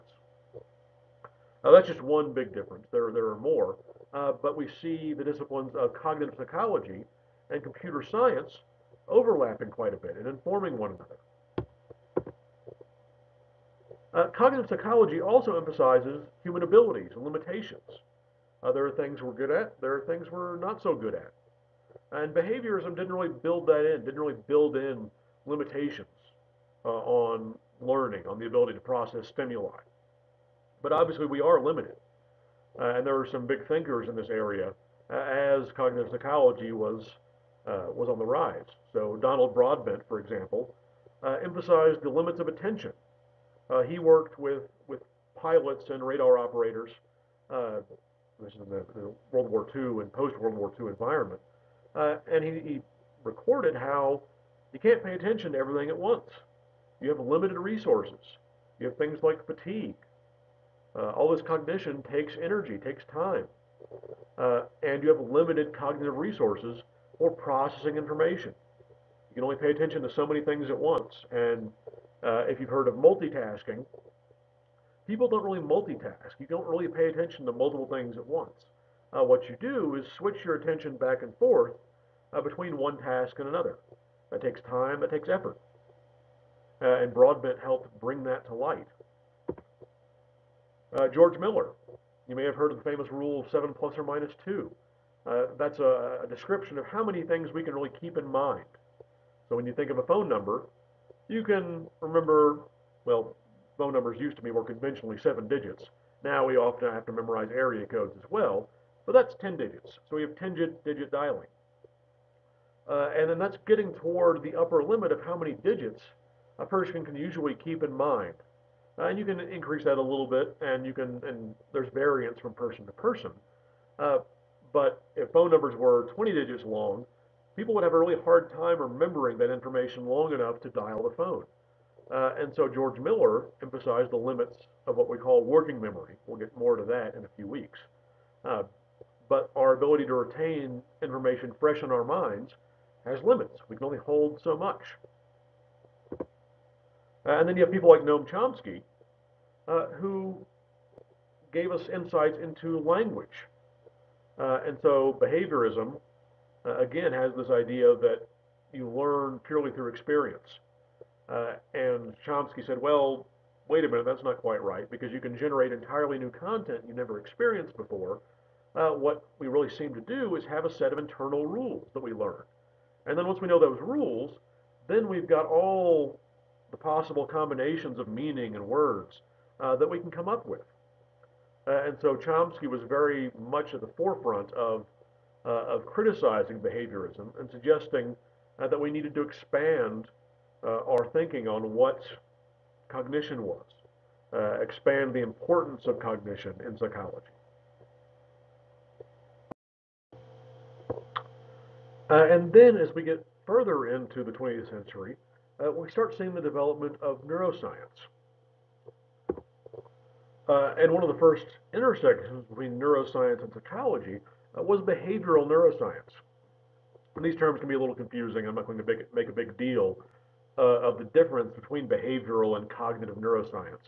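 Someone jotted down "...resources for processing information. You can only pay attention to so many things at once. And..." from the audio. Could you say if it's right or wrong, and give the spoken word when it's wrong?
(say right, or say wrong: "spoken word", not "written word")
right.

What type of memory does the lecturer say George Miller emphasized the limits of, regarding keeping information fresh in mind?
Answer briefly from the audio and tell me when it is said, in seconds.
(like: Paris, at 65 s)
working memory, at 135 s.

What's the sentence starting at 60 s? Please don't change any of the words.
Uh, all this cognition takes energy, takes time.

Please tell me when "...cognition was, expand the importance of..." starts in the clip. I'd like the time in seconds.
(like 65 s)
192 s.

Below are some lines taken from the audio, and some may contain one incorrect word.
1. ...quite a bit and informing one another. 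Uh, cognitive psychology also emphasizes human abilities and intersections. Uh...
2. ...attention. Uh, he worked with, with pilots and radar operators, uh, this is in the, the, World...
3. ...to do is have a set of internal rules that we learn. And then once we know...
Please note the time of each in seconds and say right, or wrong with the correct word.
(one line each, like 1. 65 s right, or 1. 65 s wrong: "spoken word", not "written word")
1. 9 s wrong: "limitations", not "intersections"
2. 42 s right
3. 169 s right.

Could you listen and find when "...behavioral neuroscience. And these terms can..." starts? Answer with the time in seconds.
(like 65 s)
214 s.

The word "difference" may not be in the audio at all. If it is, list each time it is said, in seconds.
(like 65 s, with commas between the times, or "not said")
2 s, 221 s.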